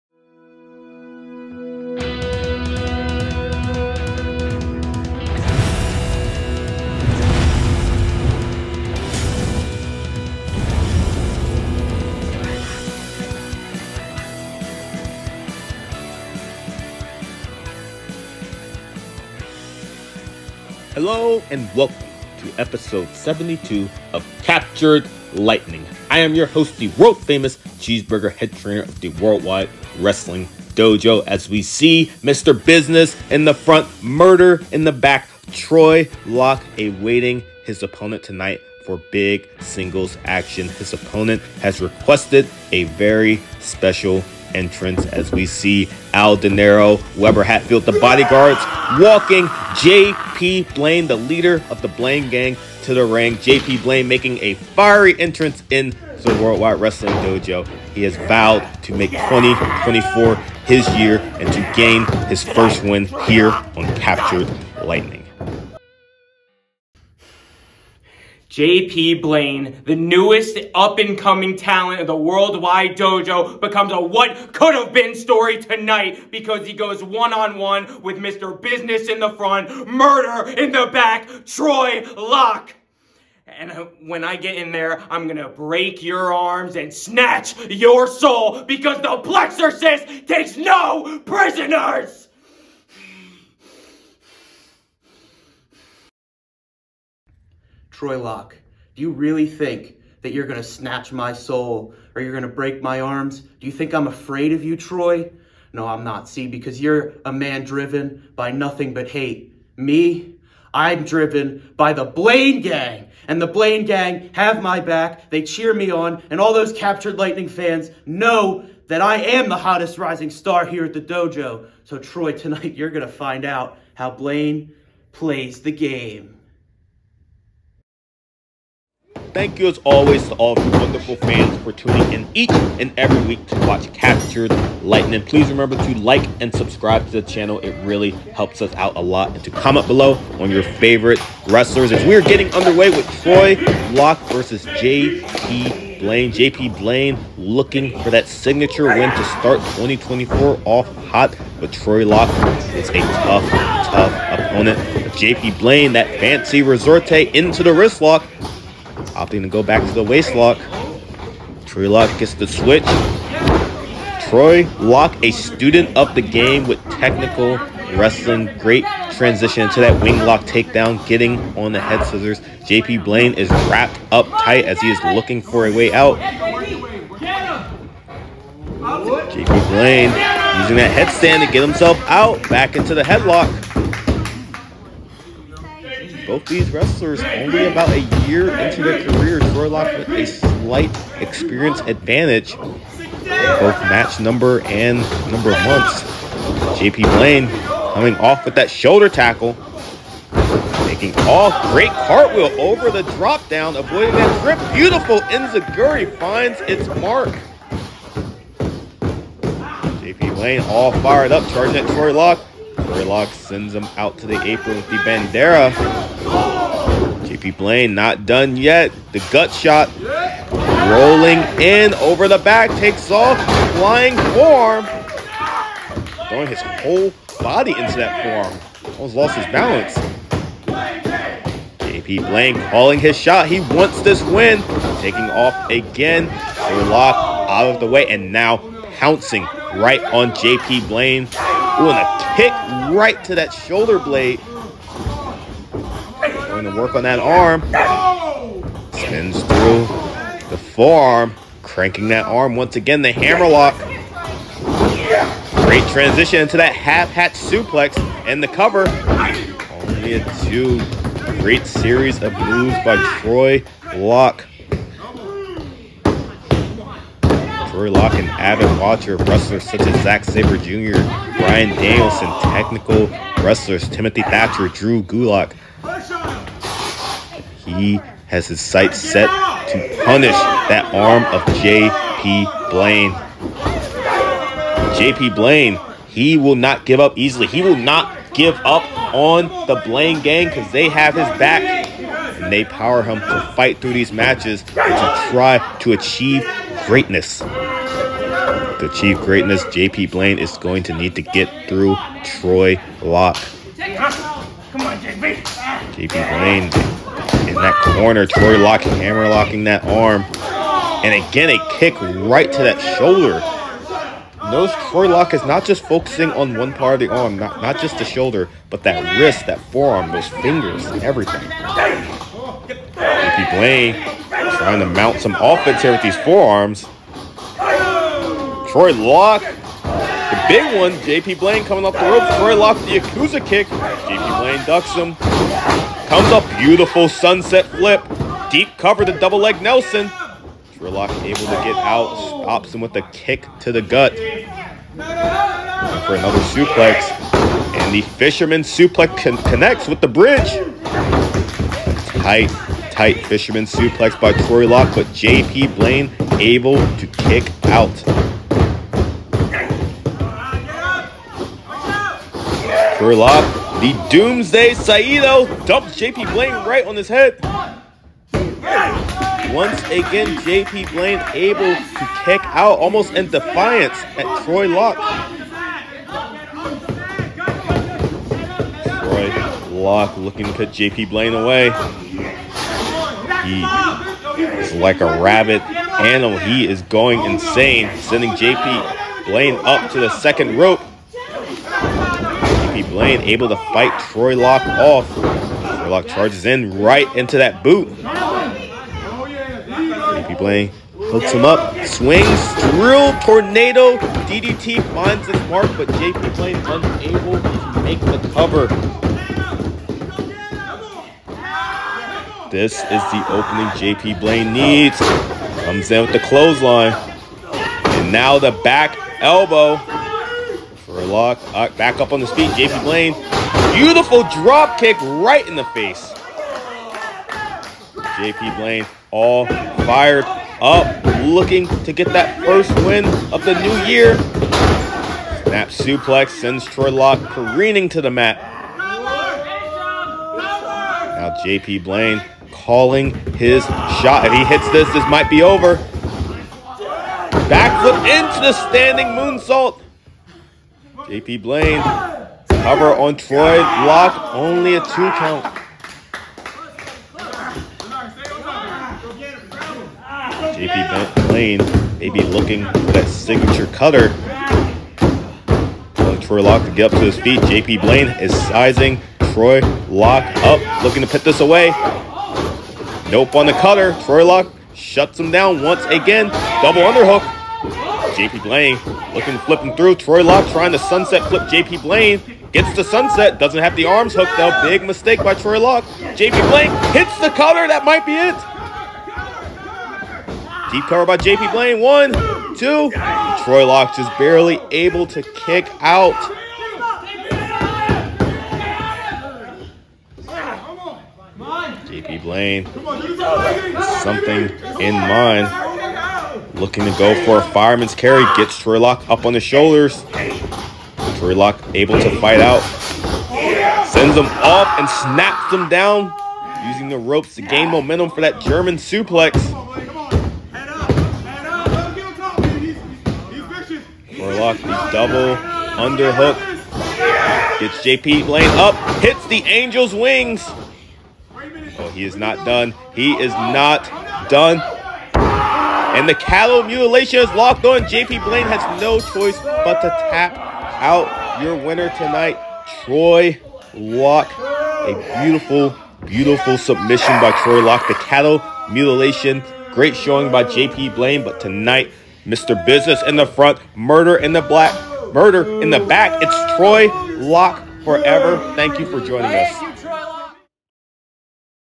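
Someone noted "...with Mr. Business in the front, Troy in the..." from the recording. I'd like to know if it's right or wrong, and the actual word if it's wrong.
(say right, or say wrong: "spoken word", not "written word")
wrong: "Murder", not "Troy".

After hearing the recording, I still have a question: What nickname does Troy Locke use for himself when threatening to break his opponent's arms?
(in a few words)
The Plexorcist.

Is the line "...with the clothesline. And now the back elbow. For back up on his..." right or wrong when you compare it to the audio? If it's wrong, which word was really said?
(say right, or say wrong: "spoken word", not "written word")
right.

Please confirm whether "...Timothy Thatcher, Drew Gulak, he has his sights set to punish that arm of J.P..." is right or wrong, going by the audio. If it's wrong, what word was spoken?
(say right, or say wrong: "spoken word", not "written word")
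right.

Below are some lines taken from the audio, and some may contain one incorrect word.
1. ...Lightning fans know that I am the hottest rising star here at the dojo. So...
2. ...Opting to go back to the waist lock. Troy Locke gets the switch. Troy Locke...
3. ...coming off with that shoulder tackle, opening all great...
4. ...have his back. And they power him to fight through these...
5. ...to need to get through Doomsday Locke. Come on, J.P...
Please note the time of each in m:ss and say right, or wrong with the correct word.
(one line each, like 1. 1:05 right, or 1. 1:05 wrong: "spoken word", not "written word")
1. 1:57 right
2. 2:39 right
3. 3:17 wrong: "making", not "opening"
4. 4:50 right
5. 5:00 wrong: "Troy", not "Doomsday".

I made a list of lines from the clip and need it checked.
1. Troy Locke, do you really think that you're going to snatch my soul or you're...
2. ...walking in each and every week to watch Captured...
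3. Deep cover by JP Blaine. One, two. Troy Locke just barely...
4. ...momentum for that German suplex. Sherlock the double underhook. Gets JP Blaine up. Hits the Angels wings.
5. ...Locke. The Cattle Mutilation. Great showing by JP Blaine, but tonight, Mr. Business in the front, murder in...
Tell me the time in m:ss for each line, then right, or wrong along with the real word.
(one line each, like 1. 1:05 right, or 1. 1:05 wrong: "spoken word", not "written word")
1. 1:38 right
2. 2:11 wrong: "tuning", not "walking"
3. 8:10 right
4. 8:37 right
5. 9:07 right.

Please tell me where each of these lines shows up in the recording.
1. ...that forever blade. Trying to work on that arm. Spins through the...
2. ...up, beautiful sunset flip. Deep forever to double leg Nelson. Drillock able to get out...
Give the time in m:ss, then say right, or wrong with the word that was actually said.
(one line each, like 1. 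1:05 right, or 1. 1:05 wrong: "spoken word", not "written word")
1. 4:03 wrong: "shoulder", not "forever"
2. 5:36 wrong: "cover", not "forever".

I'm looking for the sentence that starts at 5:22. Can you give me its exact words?
Ricky Blaine trying to mount some offense here with these forearms.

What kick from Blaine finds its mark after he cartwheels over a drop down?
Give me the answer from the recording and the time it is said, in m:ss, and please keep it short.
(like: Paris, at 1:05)
Enzuigiri, at 3:25.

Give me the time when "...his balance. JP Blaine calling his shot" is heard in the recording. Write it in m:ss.
3:49.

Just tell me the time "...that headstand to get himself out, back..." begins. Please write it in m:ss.
3:00.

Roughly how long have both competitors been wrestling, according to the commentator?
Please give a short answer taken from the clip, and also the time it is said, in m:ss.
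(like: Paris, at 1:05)
About a year, at 3:07.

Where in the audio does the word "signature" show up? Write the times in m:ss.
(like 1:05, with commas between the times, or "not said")
2:28, 7:43.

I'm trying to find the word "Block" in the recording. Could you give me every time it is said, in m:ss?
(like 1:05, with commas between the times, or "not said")
7:33.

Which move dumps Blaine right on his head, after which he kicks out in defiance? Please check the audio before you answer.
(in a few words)
Doomsday Saito.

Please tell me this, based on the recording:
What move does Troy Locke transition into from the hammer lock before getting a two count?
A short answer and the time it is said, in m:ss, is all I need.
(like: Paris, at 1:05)
Half hatch suplex, at 4:16.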